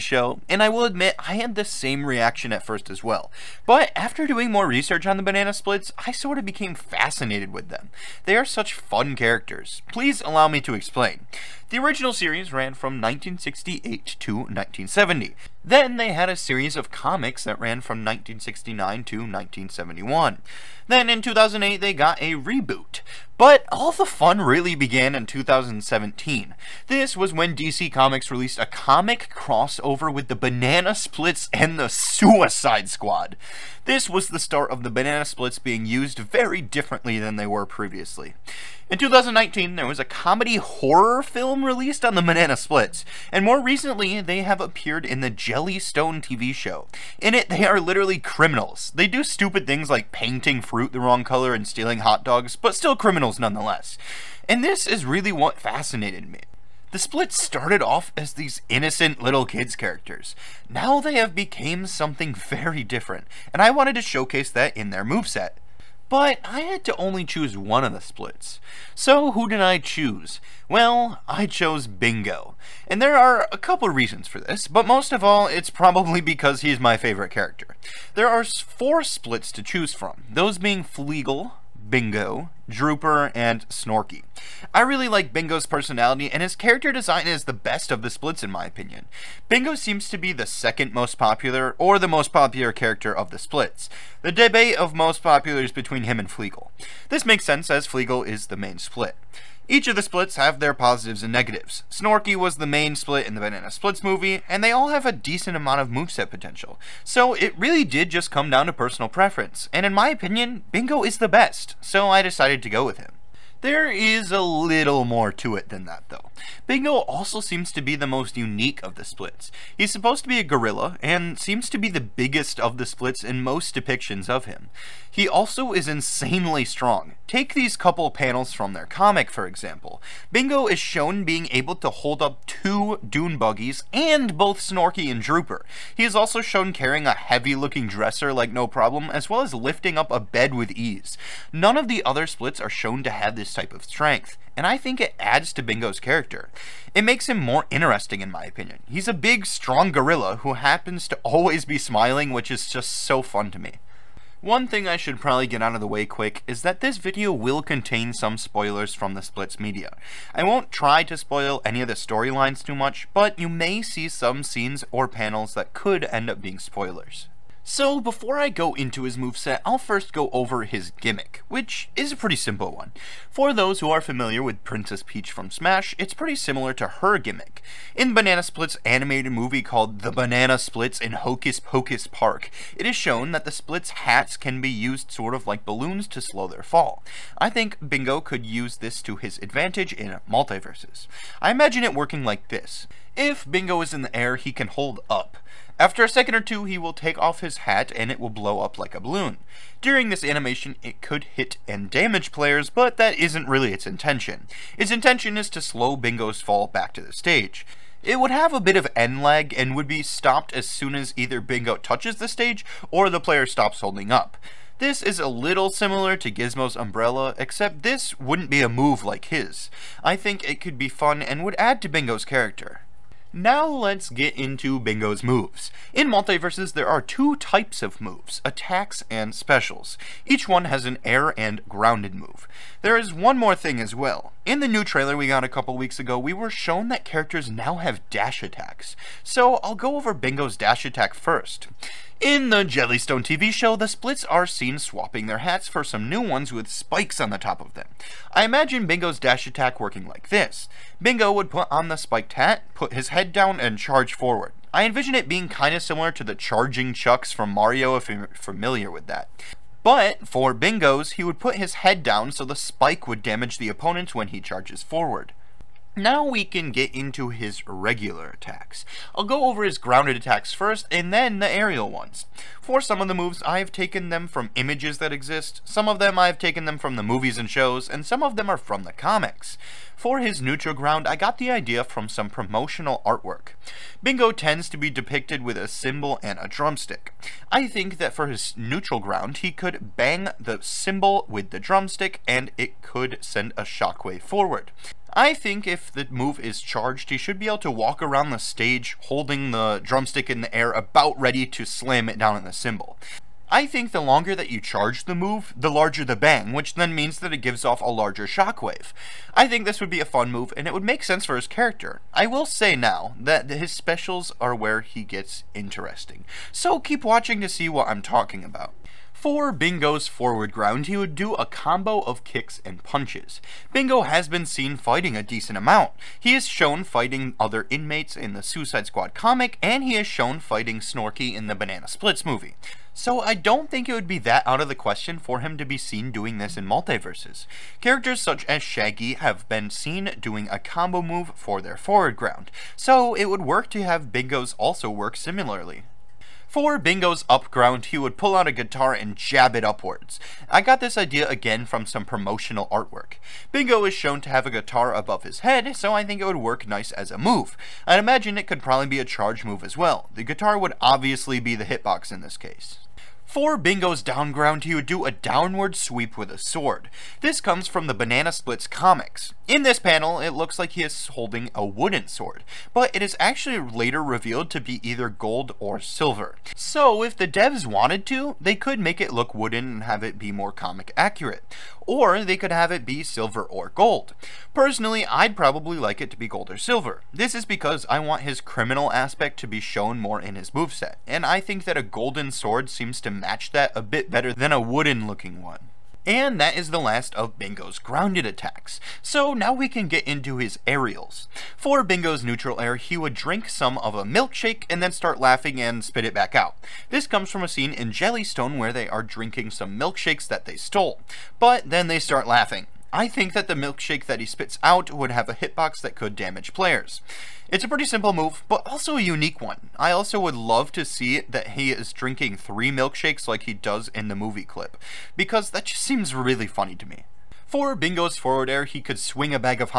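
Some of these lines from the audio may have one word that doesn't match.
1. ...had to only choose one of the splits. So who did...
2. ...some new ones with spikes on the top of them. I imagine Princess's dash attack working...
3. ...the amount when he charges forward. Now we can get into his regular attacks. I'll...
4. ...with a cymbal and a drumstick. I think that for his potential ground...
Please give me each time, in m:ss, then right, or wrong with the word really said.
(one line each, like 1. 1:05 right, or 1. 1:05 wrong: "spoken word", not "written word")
1. 1:06 right
2. 4:05 wrong: "Bingo", not "Princess"
3. 4:23 wrong: "opponent", not "amount"
4. 4:45 wrong: "neutral", not "potential".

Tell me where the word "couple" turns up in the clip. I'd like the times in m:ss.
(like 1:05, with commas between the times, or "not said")
1:13, 2:07, 3:55.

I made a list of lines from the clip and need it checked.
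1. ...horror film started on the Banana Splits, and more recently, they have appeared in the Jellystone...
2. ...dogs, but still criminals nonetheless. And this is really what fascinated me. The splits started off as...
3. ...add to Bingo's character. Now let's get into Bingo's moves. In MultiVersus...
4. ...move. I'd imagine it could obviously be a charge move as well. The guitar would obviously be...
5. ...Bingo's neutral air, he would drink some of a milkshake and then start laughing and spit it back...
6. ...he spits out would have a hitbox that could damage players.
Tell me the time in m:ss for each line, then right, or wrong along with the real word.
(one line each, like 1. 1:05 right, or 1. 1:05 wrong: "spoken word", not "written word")
1. 0:40 wrong: "released", not "started"
2. 0:52 right
3. 3:41 right
4. 5:57 wrong: "probably", not "obviously"
5. 6:41 right
6. 6:54 right.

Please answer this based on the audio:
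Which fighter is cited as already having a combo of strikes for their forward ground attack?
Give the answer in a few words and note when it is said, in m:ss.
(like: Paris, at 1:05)
Shaggy, at 5:38.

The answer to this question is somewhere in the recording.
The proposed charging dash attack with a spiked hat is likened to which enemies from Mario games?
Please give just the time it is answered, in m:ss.
4:16.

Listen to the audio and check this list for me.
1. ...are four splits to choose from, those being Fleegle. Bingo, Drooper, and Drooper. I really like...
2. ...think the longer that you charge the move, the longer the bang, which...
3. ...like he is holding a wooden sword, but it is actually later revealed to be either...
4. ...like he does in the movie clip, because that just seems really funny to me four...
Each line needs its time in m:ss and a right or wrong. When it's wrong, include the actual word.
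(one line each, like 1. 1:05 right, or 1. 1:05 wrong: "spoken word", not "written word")
1. 1:18 wrong: "Snorky", not "Drooper"
2. 5:03 wrong: "larger", not "longer"
3. 6:10 right
4. 7:03 right.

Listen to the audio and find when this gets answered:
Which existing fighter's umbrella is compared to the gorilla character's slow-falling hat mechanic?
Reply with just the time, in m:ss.
3:36.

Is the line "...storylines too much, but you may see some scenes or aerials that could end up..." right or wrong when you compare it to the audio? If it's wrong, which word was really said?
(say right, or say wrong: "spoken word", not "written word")
wrong: "panels", not "aerials".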